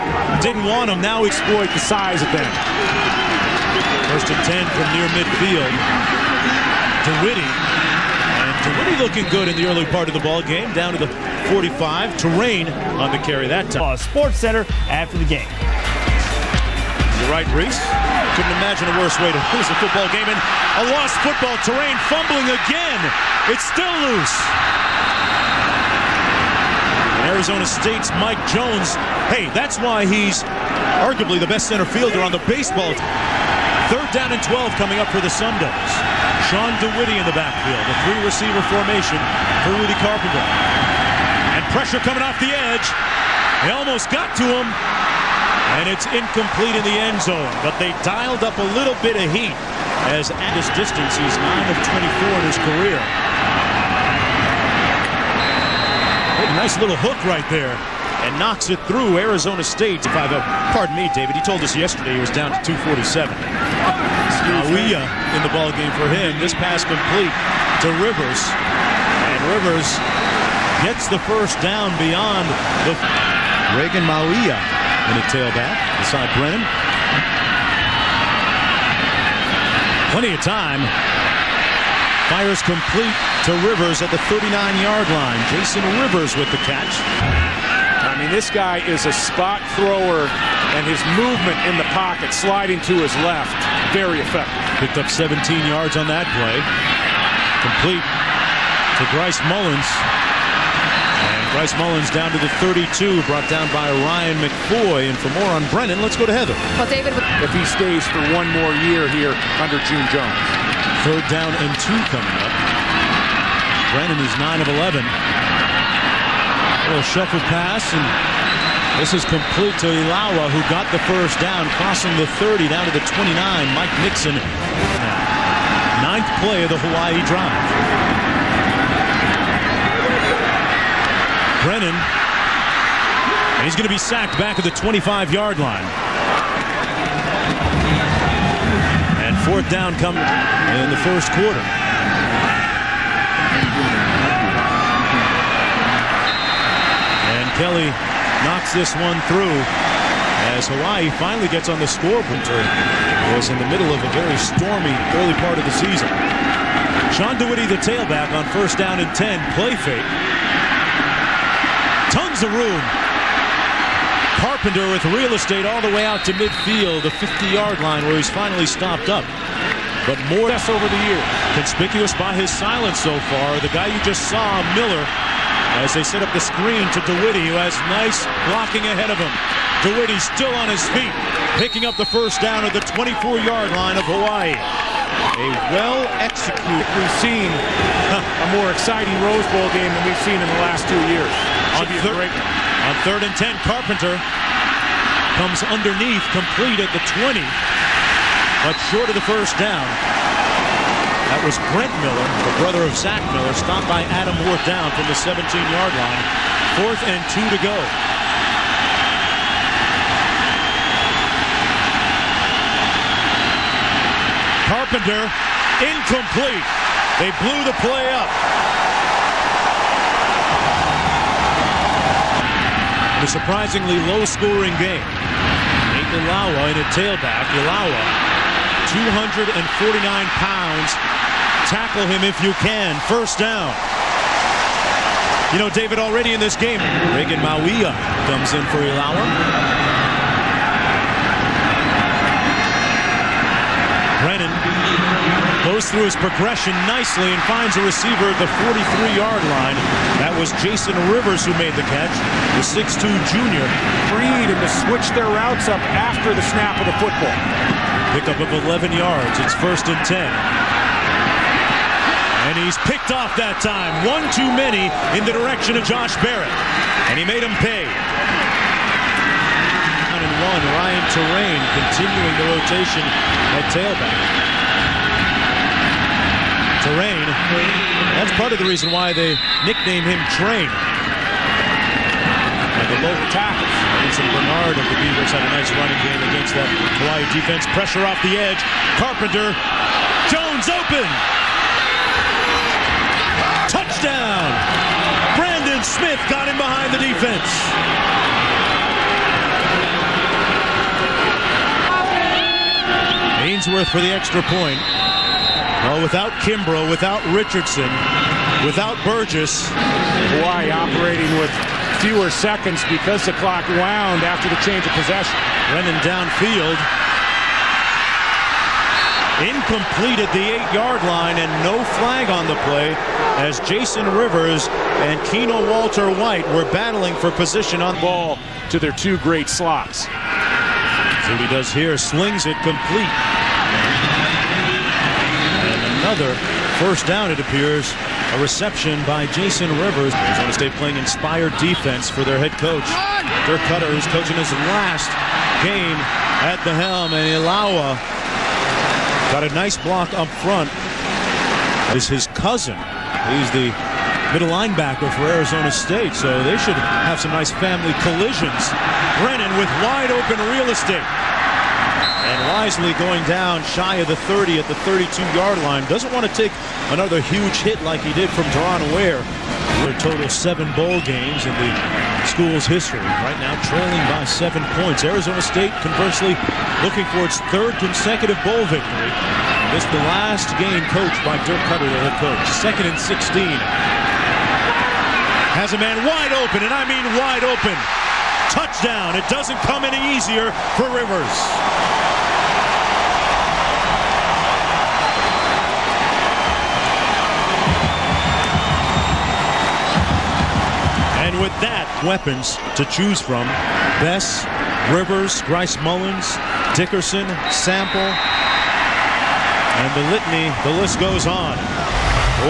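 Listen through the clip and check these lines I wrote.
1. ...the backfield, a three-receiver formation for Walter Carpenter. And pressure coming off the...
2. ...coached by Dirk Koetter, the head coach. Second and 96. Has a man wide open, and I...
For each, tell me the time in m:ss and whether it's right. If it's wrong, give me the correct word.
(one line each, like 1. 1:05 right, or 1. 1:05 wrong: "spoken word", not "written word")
1. 0:37 wrong: "Rudy", not "Walter"
2. 6:20 wrong: "16", not "96".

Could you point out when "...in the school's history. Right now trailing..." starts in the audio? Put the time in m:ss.
6:11.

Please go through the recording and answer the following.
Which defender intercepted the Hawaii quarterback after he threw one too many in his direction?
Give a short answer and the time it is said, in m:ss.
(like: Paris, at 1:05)
Josh Barrett, at 4:25.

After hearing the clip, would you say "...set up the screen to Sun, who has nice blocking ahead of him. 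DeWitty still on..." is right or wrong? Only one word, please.
wrong.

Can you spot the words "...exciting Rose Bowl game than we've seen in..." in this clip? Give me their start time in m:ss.
3:08.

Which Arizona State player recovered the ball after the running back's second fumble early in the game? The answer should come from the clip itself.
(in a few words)
Mike Jones.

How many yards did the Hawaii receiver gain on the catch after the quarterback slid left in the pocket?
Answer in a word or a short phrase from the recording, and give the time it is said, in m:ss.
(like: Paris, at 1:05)
17, at 1:35.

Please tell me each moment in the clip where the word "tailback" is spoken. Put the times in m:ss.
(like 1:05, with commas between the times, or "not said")
1:15, 2:37, 3:46, 4:33.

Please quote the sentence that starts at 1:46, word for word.
Well, David, if he stays for one more year here under June Jones.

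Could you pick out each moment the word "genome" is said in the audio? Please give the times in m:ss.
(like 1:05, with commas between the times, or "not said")
not said.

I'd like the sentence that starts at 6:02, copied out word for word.
Isley going down shy of the 30 at the 32-yard line.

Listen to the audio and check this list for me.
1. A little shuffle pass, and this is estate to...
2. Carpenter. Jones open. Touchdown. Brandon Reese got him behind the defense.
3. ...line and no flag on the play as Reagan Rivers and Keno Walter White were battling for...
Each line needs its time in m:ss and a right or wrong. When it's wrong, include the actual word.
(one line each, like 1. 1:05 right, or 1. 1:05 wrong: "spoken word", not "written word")
1. 1:55 wrong: "complete", not "estate"
2. 4:49 wrong: "Smith", not "Reese"
3. 5:21 wrong: "Jason", not "Reagan".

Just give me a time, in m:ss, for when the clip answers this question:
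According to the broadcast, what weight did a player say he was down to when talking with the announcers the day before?
1:02.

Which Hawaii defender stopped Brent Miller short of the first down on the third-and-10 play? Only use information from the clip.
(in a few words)
Adam Ward.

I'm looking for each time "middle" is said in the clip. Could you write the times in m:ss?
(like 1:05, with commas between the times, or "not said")
2:33, 5:54.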